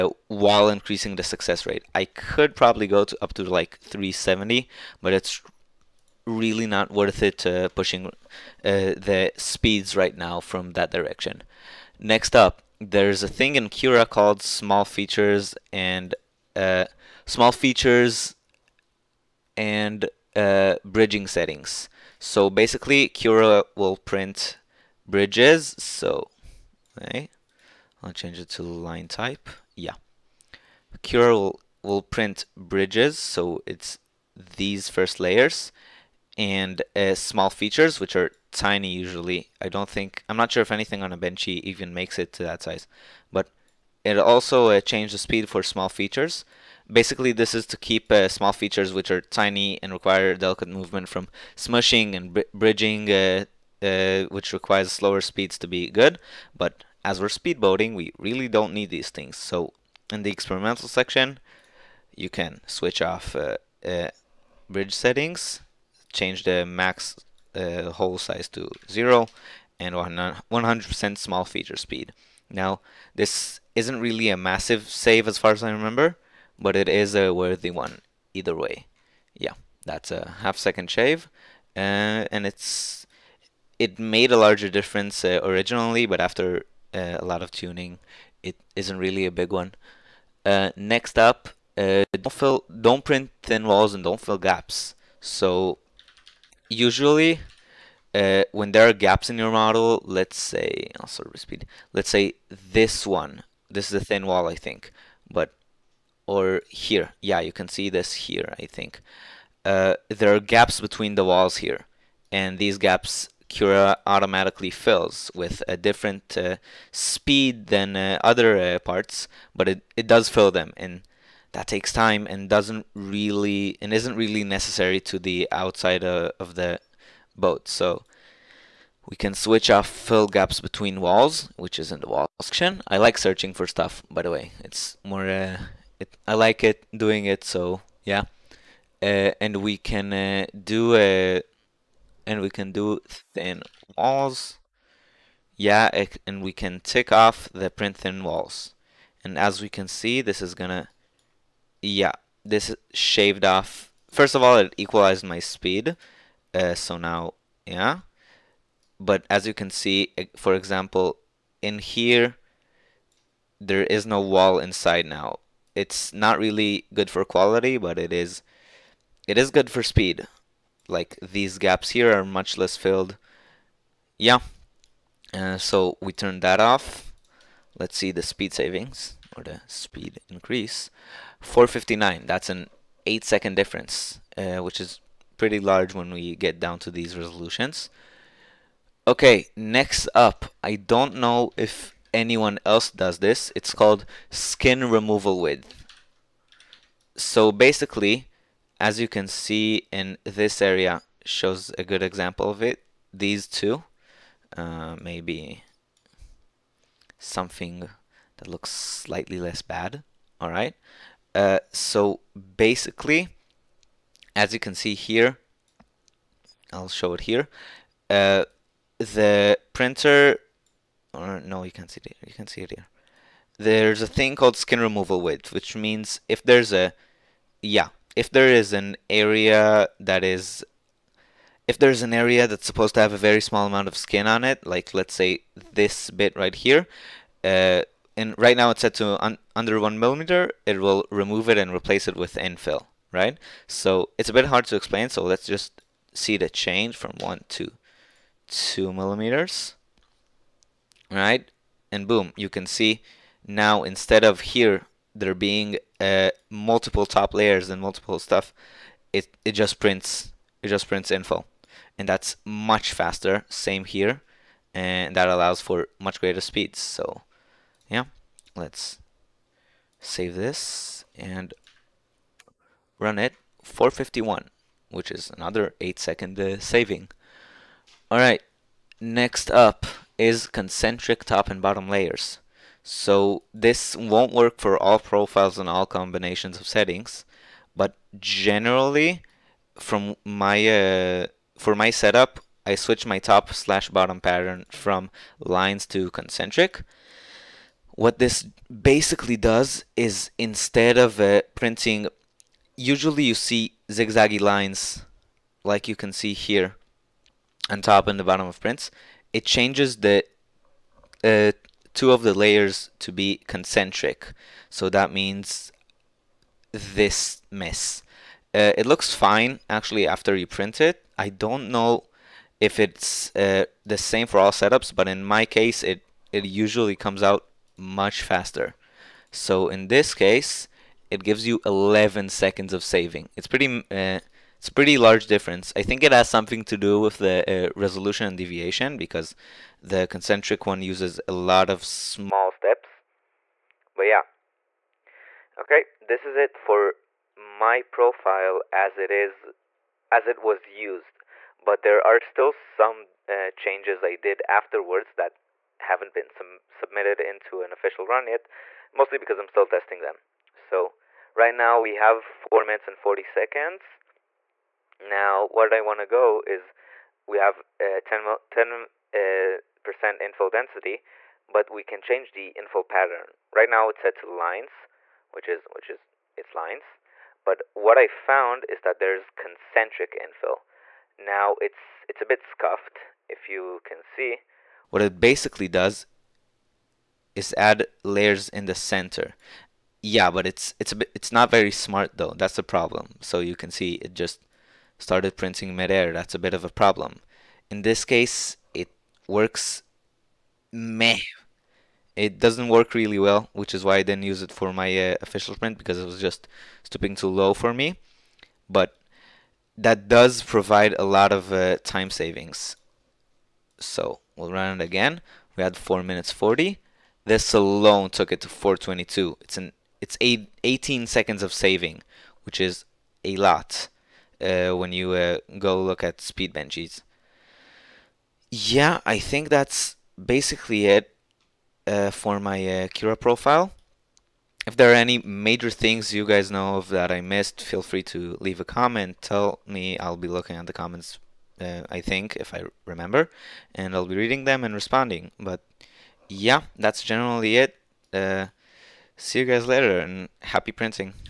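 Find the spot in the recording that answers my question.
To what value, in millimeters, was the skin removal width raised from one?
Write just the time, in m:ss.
4:08.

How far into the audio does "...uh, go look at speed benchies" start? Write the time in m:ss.
7:05.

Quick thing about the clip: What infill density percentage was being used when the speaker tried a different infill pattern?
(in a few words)
10 percent.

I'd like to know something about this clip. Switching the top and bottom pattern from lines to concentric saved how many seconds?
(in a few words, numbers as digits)
11 seconds.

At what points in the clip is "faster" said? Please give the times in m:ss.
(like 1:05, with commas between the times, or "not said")
4:22, 5:28.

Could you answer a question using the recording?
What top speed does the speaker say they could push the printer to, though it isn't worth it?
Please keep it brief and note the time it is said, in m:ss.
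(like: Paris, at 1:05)
370, at 0:03.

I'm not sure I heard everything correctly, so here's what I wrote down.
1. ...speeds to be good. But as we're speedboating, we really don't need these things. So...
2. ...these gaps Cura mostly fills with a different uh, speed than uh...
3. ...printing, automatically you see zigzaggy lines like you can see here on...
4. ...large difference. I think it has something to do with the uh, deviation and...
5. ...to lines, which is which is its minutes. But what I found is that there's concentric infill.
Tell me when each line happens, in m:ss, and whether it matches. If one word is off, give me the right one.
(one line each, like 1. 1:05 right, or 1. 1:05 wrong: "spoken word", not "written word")
1. 0:55 right
2. 1:52 wrong: "automatically", not "mostly"
3. 5:01 wrong: "usually", not "automatically"
4. 5:34 wrong: "resolution", not "deviation"
5. 6:14 wrong: "lines", not "minutes".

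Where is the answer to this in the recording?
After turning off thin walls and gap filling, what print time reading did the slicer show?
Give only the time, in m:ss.
3:01.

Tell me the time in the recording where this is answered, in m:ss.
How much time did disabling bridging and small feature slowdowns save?
1:20.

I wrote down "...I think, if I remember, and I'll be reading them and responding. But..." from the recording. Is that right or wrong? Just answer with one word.
right.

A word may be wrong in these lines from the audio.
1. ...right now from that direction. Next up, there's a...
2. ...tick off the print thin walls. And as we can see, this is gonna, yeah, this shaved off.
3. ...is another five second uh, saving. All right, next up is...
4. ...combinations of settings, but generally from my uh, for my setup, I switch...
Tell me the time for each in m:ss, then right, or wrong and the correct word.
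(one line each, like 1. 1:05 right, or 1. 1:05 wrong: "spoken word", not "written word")
1. 0:09 right
2. 2:26 right
3. 4:35 wrong: "eight", not "five"
4. 4:45 right.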